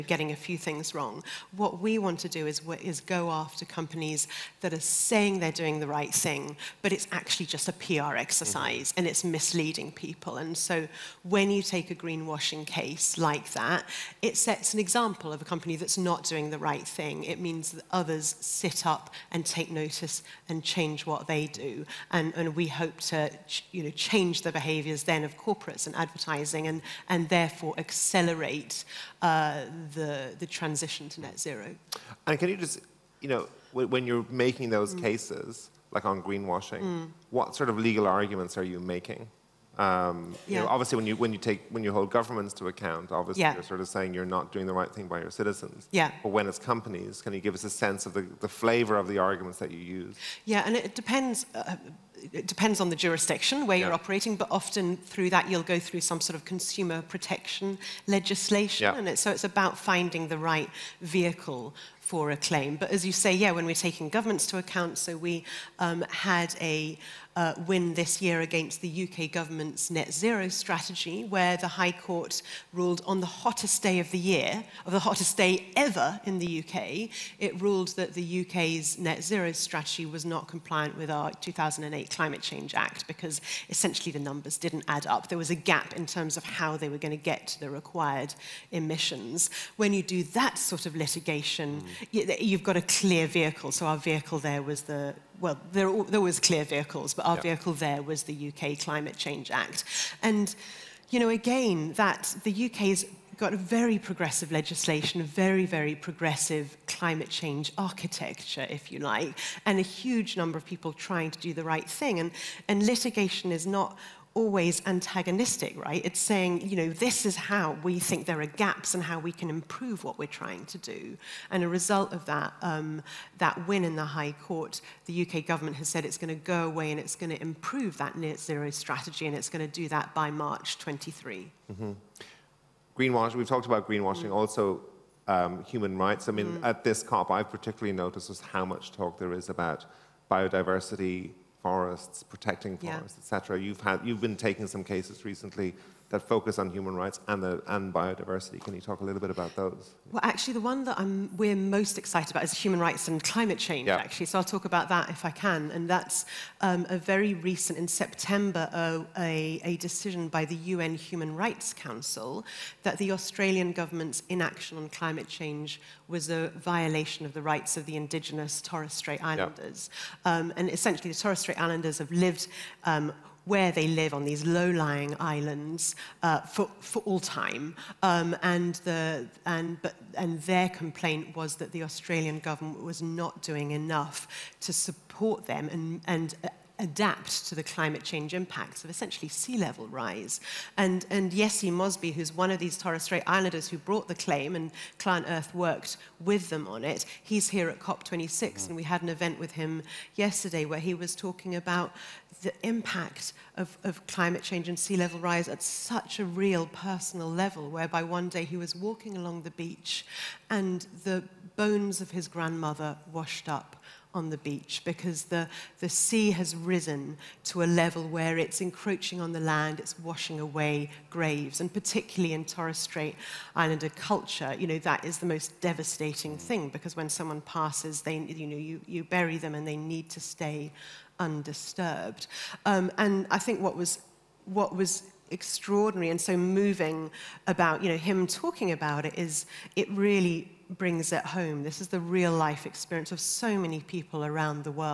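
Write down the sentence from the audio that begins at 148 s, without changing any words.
Can you talk a little bit about those?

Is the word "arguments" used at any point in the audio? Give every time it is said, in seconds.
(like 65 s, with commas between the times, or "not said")
38 s, 49 s.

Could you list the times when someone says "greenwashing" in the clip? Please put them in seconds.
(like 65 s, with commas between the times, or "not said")
11 s, 36 s, 133 s.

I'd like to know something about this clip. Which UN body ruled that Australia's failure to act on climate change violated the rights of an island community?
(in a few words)
UN Human Rights Council.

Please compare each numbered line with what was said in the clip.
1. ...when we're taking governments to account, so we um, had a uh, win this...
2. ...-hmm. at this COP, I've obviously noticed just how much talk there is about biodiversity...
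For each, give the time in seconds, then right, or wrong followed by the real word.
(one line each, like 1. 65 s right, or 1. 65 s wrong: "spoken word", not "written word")
1. 63 s right
2. 136 s wrong: "particularly", not "obviously".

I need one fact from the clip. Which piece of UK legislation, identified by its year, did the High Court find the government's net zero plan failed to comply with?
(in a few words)
2008 Climate Change Act.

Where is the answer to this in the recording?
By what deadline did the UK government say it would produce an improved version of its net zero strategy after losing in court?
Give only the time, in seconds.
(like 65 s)
130 s.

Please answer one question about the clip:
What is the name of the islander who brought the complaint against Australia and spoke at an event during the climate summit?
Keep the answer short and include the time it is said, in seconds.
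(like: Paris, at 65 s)
Yessi Mosby, at 191 s.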